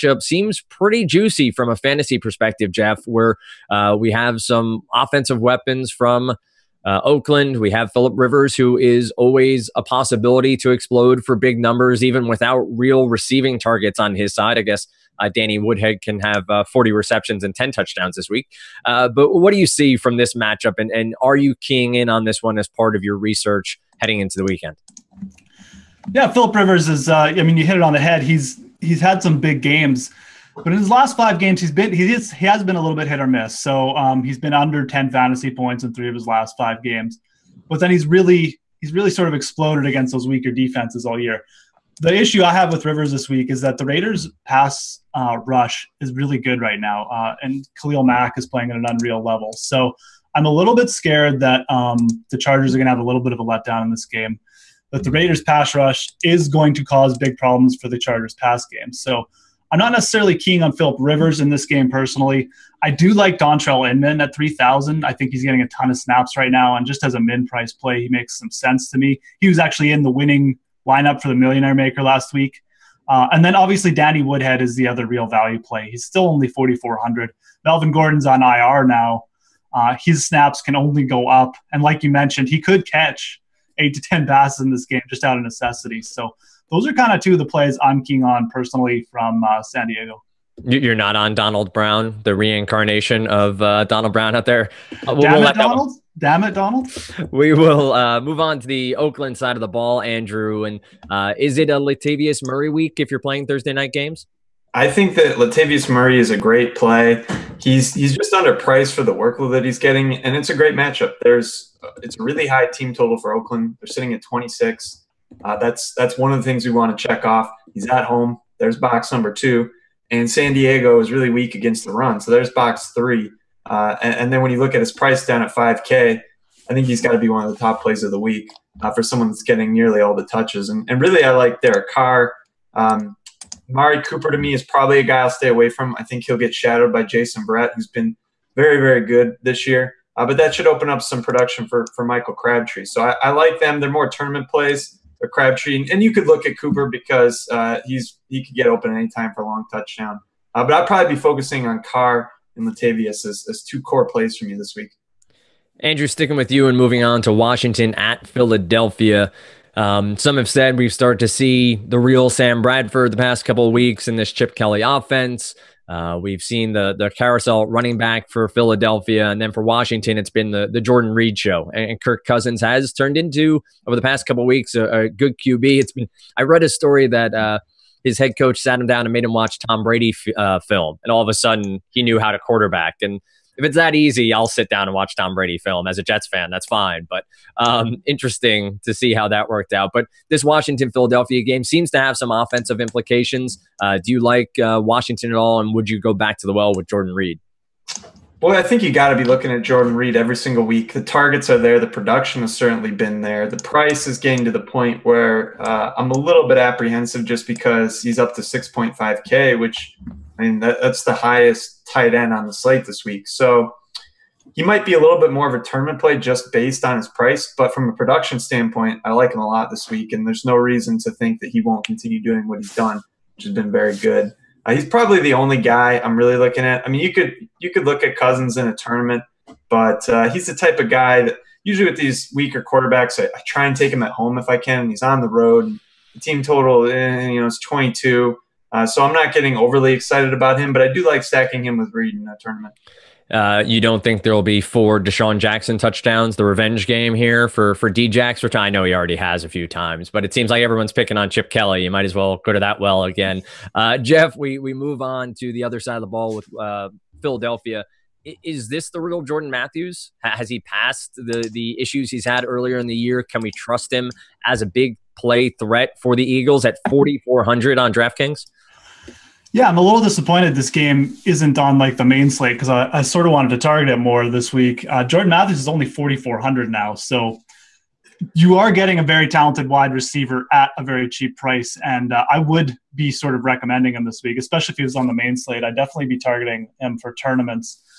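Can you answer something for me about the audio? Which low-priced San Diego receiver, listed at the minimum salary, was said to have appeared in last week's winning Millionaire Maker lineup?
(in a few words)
Dontrelle Inman.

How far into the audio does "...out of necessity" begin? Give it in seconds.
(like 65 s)
85 s.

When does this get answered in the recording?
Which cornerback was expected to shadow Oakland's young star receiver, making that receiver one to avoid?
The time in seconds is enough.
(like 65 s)
137 s.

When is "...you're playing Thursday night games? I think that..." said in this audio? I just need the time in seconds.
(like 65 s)
103 s.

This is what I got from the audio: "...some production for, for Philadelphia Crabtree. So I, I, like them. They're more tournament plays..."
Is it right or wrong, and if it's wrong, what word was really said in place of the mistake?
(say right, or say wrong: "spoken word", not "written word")
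wrong: "Michael", not "Philadelphia".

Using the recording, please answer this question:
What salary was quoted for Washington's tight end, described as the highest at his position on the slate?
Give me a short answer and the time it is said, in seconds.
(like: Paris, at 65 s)
6.5K, at 208 s.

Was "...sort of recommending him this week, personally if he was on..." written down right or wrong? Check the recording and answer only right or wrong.
wrong.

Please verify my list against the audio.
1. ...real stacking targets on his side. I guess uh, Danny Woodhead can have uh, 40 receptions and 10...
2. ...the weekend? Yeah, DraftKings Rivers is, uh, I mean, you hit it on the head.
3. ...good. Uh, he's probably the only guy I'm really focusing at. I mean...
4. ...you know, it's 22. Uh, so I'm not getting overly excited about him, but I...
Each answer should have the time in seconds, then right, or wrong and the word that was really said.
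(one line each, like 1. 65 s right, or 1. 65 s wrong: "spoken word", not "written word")
1. 12 s wrong: "receiving", not "stacking"
2. 24 s wrong: "Philip", not "DraftKings"
3. 223 s wrong: "looking", not "focusing"
4. 237 s right.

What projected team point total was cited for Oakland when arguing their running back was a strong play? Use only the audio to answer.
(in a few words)
26.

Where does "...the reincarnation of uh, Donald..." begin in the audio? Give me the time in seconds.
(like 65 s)
92 s.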